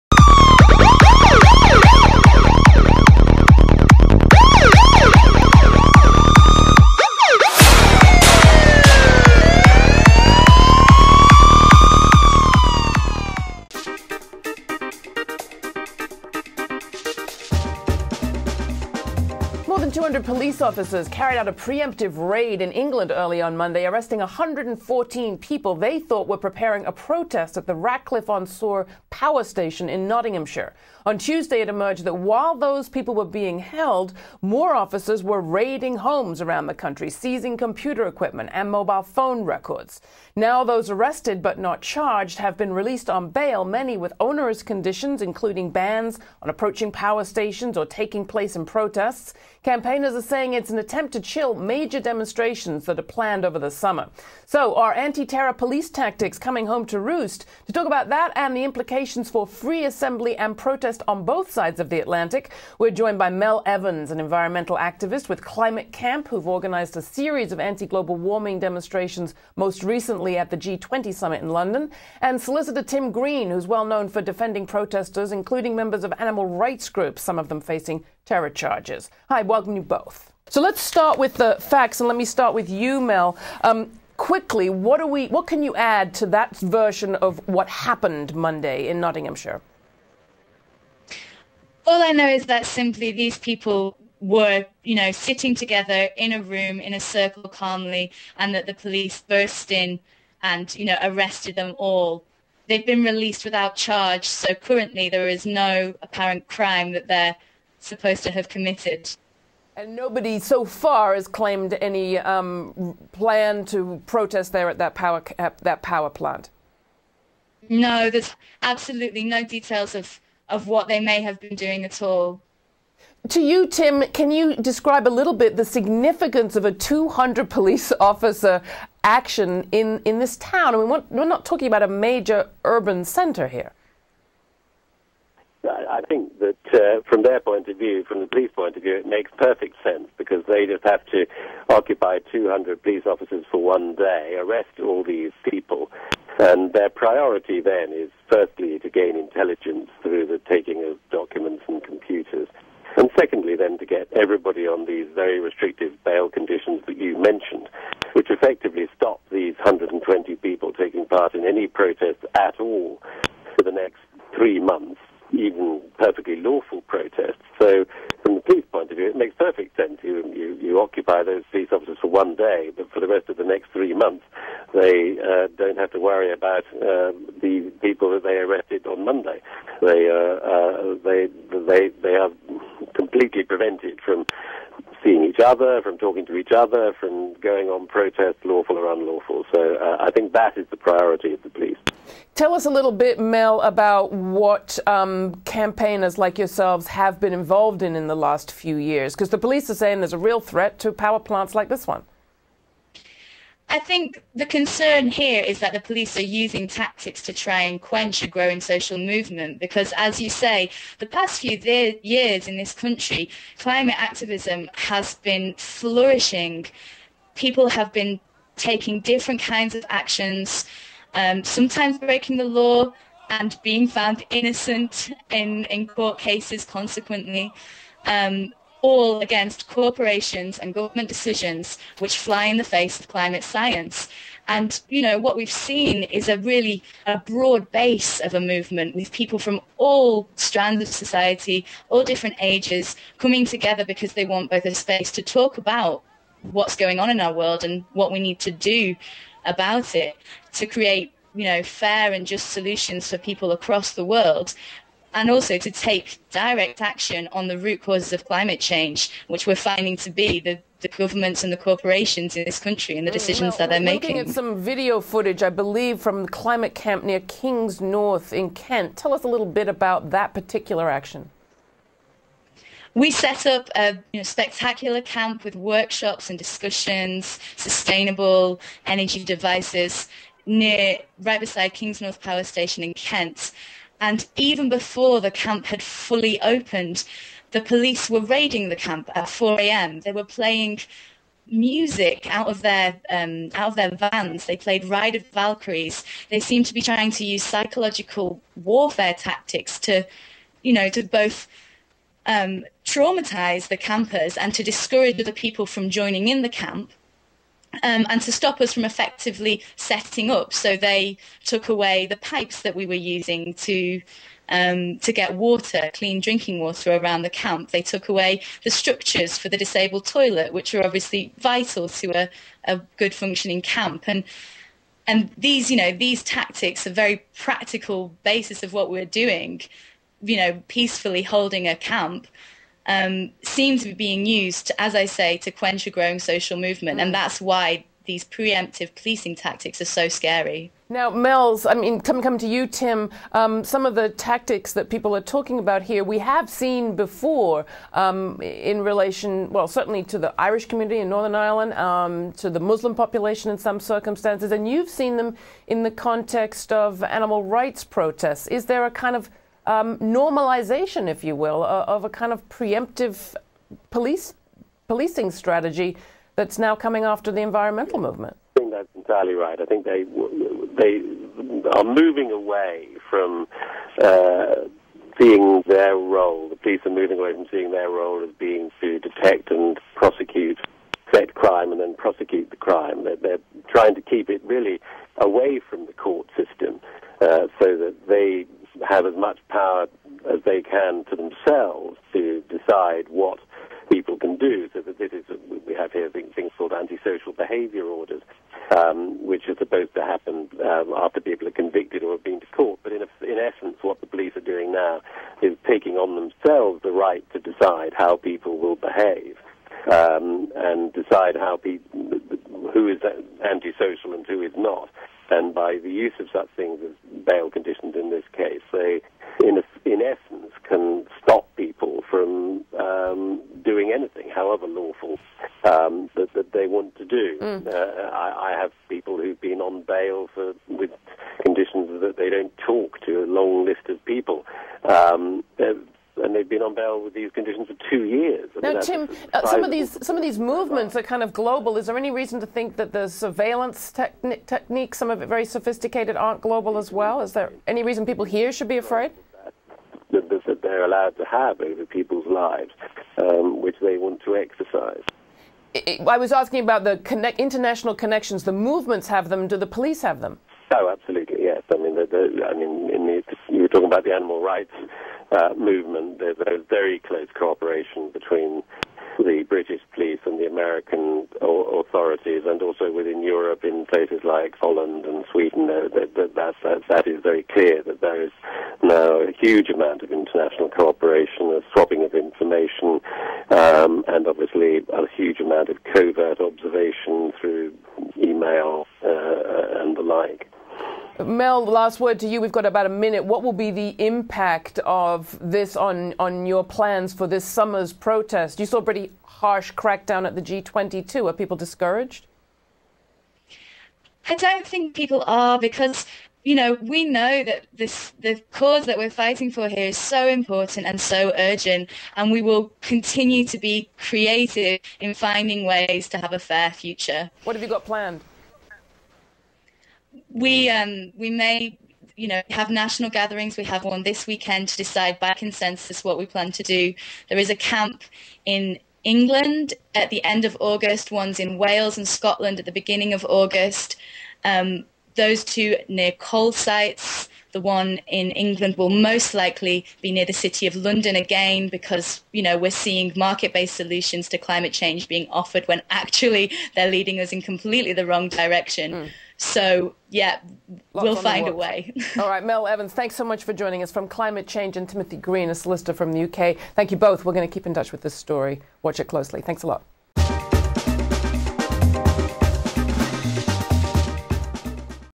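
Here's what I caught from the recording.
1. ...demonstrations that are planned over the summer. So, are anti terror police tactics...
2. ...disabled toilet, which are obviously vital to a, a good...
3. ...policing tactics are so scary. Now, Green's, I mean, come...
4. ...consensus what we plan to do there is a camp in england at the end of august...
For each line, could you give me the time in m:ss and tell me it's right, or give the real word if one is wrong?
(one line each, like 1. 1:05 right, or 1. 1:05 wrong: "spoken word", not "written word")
1. 0:51 right
2. 5:19 right
3. 5:38 wrong: "Mel", not "Green"
4. 8:45 right.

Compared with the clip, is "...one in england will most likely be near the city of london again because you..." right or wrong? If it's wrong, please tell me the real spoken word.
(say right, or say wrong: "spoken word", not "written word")
right.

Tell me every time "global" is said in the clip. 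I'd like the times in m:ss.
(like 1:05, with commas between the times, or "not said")
1:07, 7:21, 7:26.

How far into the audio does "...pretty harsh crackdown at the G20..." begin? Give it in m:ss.
8:18.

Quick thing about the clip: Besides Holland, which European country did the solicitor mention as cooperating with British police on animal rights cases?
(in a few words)
Sweden.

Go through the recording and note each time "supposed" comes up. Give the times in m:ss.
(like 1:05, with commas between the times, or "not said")
1:47, 6:39.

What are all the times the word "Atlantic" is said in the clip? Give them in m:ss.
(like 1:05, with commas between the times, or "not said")
1:02.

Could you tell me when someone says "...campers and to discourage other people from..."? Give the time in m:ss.
5:03.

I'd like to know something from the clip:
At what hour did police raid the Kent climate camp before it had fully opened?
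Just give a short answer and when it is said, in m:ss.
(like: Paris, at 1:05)
4 a.m., at 4:49.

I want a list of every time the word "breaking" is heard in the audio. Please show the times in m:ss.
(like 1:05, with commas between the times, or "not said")
3:41.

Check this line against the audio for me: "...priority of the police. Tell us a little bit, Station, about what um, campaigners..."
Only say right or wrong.
wrong.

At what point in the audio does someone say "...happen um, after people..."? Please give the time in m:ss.
6:40.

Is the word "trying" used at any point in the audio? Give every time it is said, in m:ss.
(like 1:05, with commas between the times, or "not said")
4:56, 6:23.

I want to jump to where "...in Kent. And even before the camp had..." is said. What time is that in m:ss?
4:42.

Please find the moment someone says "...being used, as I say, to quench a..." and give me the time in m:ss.
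5:33.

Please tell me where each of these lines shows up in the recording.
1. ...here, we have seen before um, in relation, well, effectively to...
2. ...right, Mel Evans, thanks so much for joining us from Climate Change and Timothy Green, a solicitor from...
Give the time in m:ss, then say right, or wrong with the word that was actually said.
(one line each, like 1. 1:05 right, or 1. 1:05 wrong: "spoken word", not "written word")
1. 5:45 wrong: "certainly", not "effectively"
2. 9:12 right.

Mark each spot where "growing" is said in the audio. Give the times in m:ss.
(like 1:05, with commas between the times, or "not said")
3:28, 5:35.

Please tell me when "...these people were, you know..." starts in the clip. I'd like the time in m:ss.
1:33.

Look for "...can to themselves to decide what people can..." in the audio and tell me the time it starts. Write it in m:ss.
6:30.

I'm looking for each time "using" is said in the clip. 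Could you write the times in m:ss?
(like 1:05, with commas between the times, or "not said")
3:26, 5:12.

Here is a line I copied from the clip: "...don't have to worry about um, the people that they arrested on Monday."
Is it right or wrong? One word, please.
right.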